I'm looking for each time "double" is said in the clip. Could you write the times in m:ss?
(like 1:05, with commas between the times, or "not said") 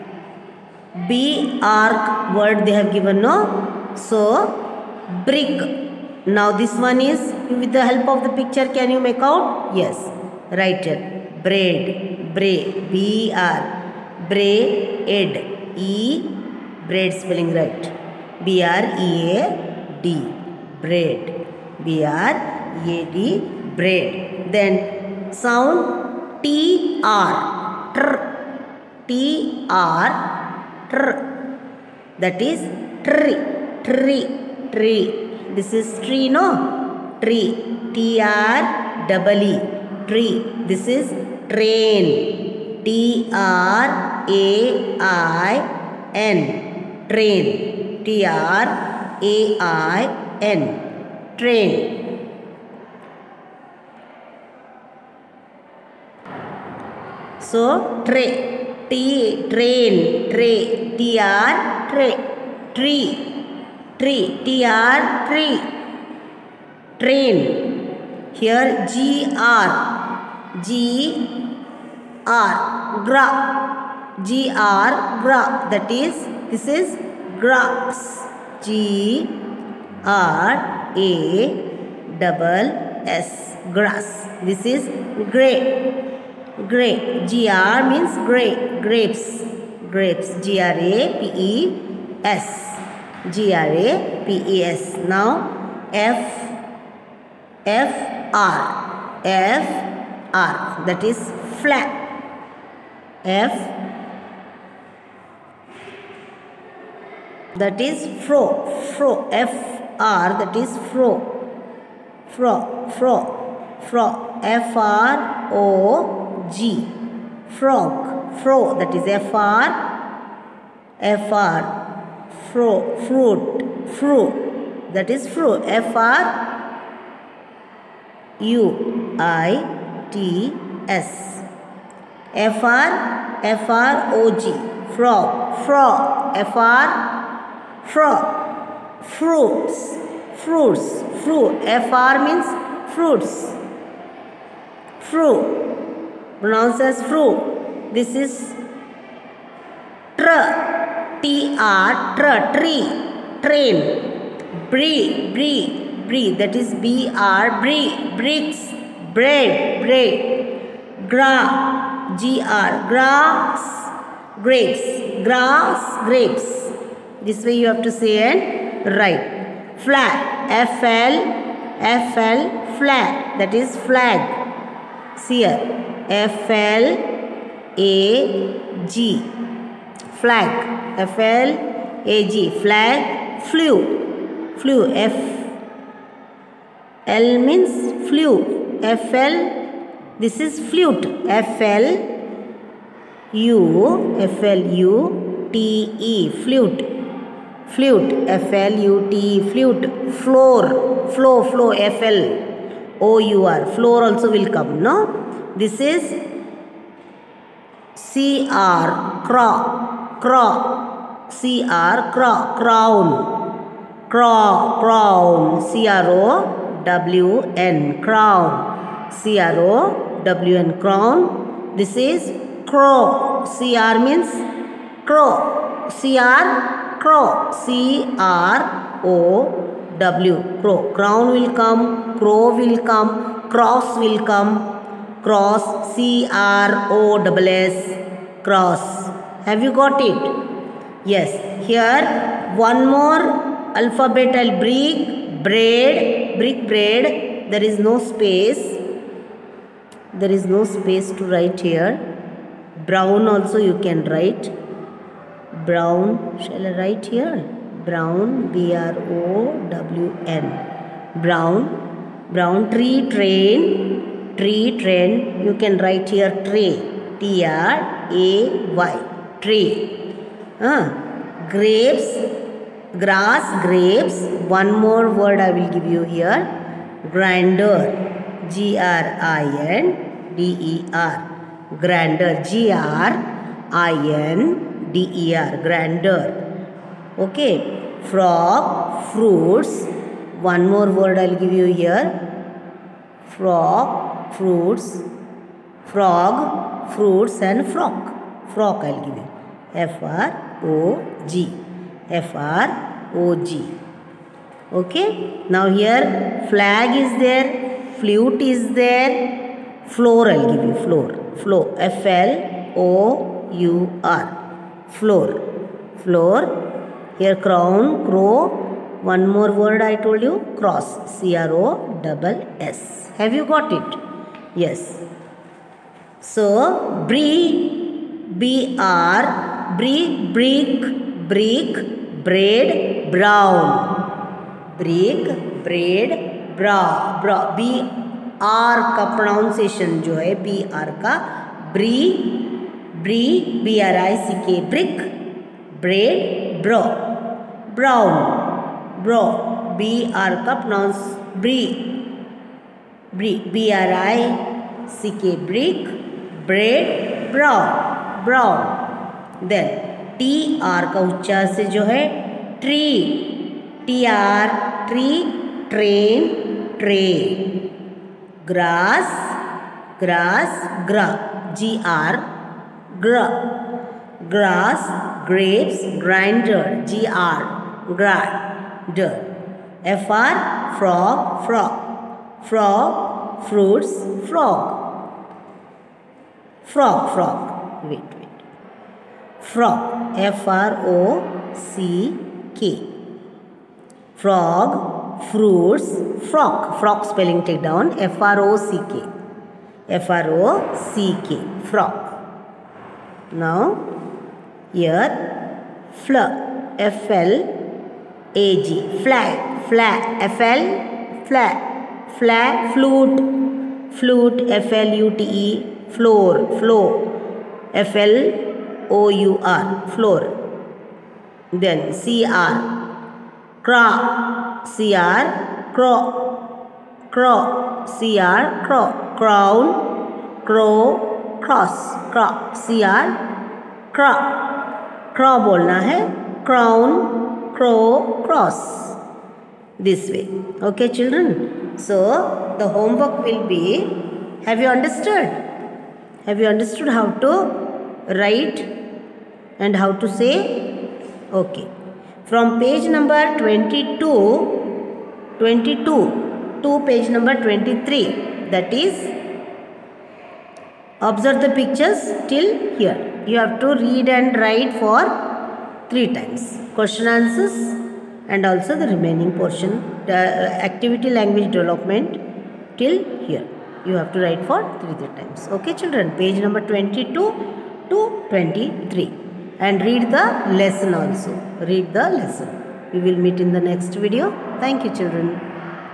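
0:39, 1:22.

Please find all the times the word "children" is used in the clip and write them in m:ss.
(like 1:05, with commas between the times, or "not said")
7:20, 7:55, 8:04.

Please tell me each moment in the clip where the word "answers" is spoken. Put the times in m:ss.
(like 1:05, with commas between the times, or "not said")
7:47.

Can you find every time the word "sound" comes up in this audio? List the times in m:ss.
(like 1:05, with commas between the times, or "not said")
0:25.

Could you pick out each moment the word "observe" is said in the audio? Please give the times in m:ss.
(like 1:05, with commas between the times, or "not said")
7:41.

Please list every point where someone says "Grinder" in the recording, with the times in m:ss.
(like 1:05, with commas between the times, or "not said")
4:37, 4:45.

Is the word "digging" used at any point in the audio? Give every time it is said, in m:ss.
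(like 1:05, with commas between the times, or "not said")
not said.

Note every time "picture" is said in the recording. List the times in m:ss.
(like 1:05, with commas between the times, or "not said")
0:08, 7:41.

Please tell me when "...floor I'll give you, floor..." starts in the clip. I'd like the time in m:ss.
5:09.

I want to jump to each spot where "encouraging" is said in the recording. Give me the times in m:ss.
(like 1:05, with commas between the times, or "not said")
not said.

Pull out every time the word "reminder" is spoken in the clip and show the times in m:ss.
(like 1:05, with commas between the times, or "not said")
not said.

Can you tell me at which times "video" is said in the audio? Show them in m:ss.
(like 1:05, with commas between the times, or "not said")
8:03.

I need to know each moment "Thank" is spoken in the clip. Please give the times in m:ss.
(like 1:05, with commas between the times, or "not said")
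8:04.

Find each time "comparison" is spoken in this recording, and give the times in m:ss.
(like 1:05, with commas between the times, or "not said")
not said.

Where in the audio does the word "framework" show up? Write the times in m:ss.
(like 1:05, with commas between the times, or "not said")
not said.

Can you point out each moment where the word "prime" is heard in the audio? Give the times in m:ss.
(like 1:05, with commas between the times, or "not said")
not said.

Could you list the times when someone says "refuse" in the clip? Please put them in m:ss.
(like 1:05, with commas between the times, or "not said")
not said.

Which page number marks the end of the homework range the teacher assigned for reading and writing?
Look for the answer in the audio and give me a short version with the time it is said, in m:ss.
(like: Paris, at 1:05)
23, at 7:36.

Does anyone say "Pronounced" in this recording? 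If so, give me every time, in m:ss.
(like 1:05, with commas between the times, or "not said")
2:26.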